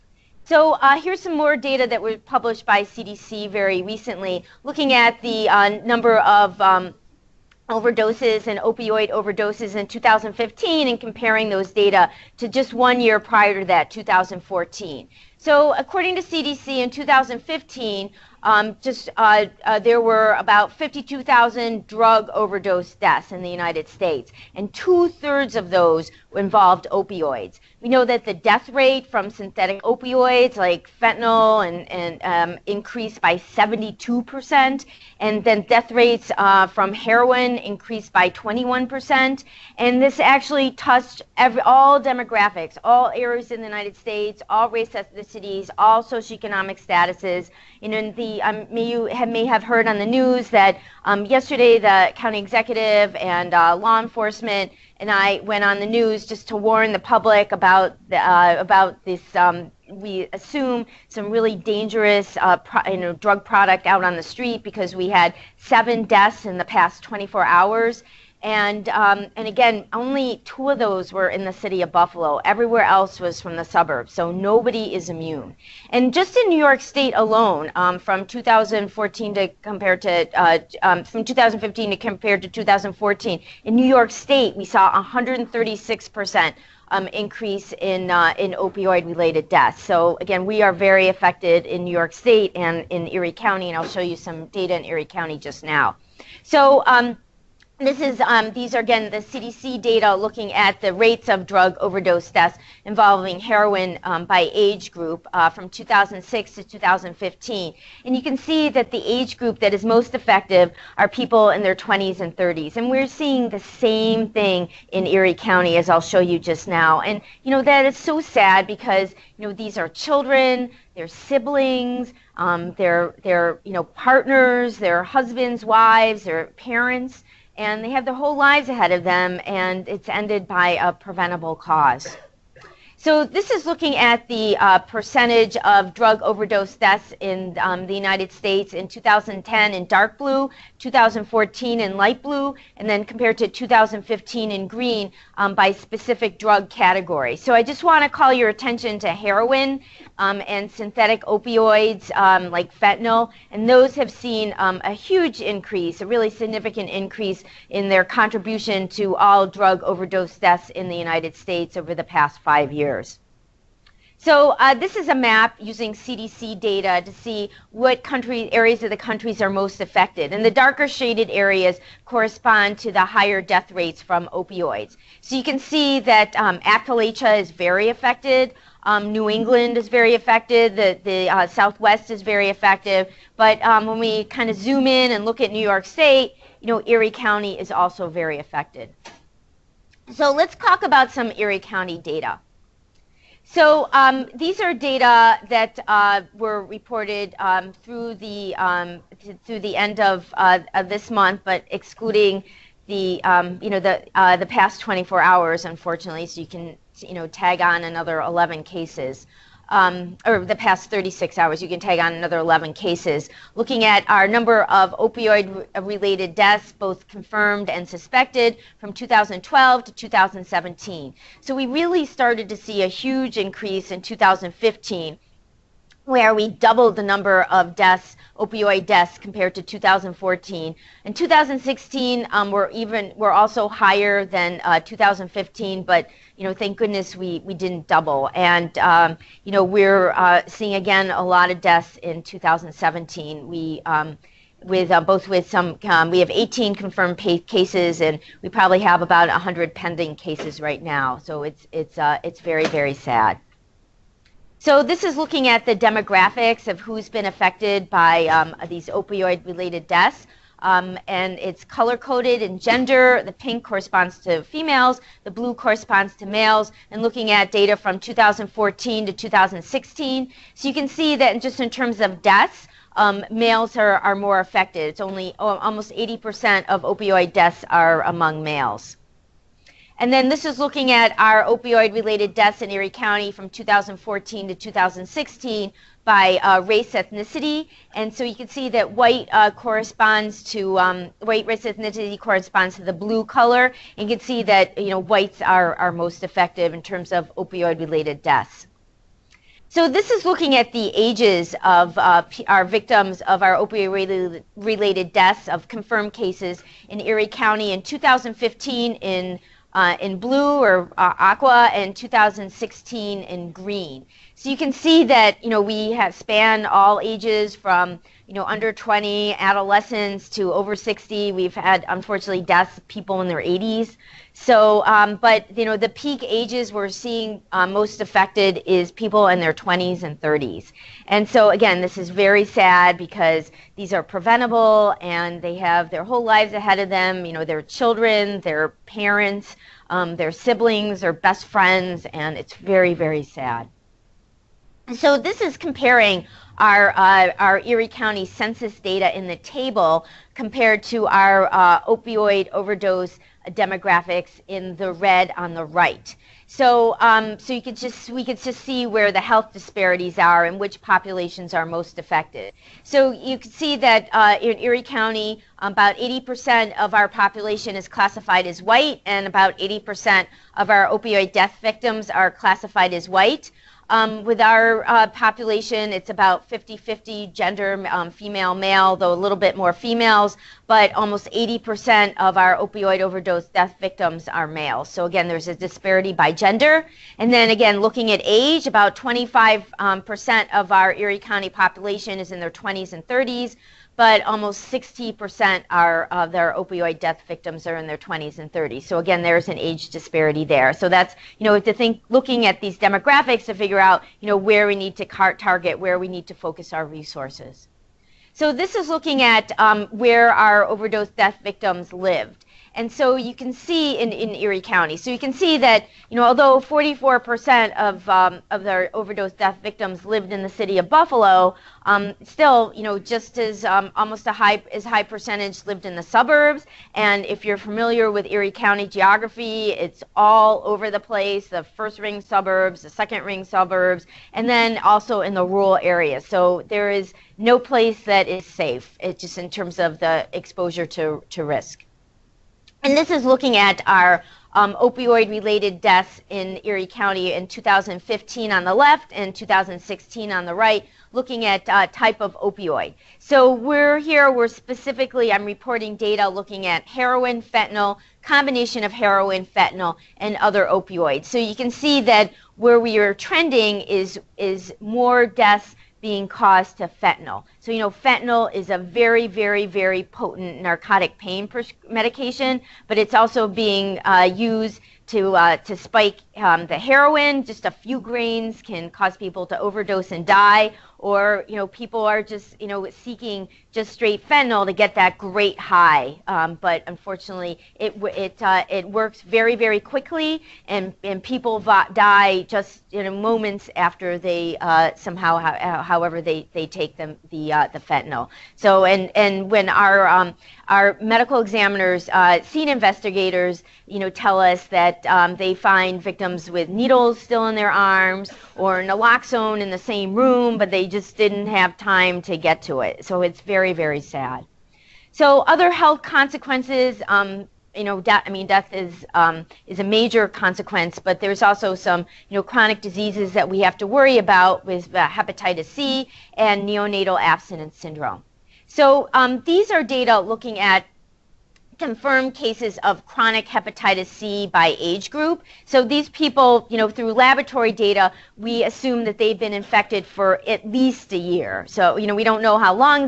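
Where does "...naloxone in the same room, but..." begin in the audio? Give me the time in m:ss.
8:28.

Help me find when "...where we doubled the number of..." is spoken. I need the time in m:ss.
3:46.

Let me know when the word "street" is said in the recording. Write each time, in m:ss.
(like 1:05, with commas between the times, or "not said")
1:04.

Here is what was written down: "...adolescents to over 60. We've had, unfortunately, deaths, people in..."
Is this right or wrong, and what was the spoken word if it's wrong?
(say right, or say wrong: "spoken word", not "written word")
right.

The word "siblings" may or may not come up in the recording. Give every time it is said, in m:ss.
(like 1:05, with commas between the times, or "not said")
2:01, 5:40.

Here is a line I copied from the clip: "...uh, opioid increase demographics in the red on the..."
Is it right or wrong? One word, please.
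wrong.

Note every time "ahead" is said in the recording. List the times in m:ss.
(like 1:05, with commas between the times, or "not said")
2:08, 5:36.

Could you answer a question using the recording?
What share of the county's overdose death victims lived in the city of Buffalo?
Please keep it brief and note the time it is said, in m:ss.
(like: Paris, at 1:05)
44%, at 6:56.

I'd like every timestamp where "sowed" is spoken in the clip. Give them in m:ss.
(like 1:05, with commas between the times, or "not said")
not said.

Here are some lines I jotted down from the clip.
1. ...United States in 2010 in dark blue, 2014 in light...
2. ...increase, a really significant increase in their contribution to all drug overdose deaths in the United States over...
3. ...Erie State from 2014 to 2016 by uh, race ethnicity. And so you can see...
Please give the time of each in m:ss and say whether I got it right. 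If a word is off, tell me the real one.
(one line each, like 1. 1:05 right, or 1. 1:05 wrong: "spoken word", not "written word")
1. 2:17 right
2. 2:35 right
3. 4:42 wrong: "County", not "State".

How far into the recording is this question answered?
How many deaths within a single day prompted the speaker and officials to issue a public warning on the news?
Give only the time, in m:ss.
1:05.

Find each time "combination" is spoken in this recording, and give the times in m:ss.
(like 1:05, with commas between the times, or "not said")
7:38.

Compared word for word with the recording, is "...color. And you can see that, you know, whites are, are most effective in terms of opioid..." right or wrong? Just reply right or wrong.
right.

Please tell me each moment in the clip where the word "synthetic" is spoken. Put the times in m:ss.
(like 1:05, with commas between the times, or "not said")
0:29, 2:30.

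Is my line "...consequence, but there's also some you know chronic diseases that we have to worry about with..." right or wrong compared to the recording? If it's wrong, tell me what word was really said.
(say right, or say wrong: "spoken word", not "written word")
right.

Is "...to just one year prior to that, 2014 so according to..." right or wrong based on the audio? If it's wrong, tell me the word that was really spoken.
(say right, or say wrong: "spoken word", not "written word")
right.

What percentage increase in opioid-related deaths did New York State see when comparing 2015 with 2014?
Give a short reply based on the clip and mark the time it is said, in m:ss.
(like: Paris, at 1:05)
136 percent, at 1:24.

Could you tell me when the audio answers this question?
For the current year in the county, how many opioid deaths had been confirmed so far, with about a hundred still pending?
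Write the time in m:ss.
4:06.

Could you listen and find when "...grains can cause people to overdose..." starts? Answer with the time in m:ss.
7:57.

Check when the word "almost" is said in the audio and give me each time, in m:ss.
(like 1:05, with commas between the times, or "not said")
4:35, 6:20, 6:34, 7:03.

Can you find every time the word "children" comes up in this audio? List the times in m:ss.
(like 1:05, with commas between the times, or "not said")
1:59, 5:37.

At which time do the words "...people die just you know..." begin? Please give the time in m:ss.
8:11.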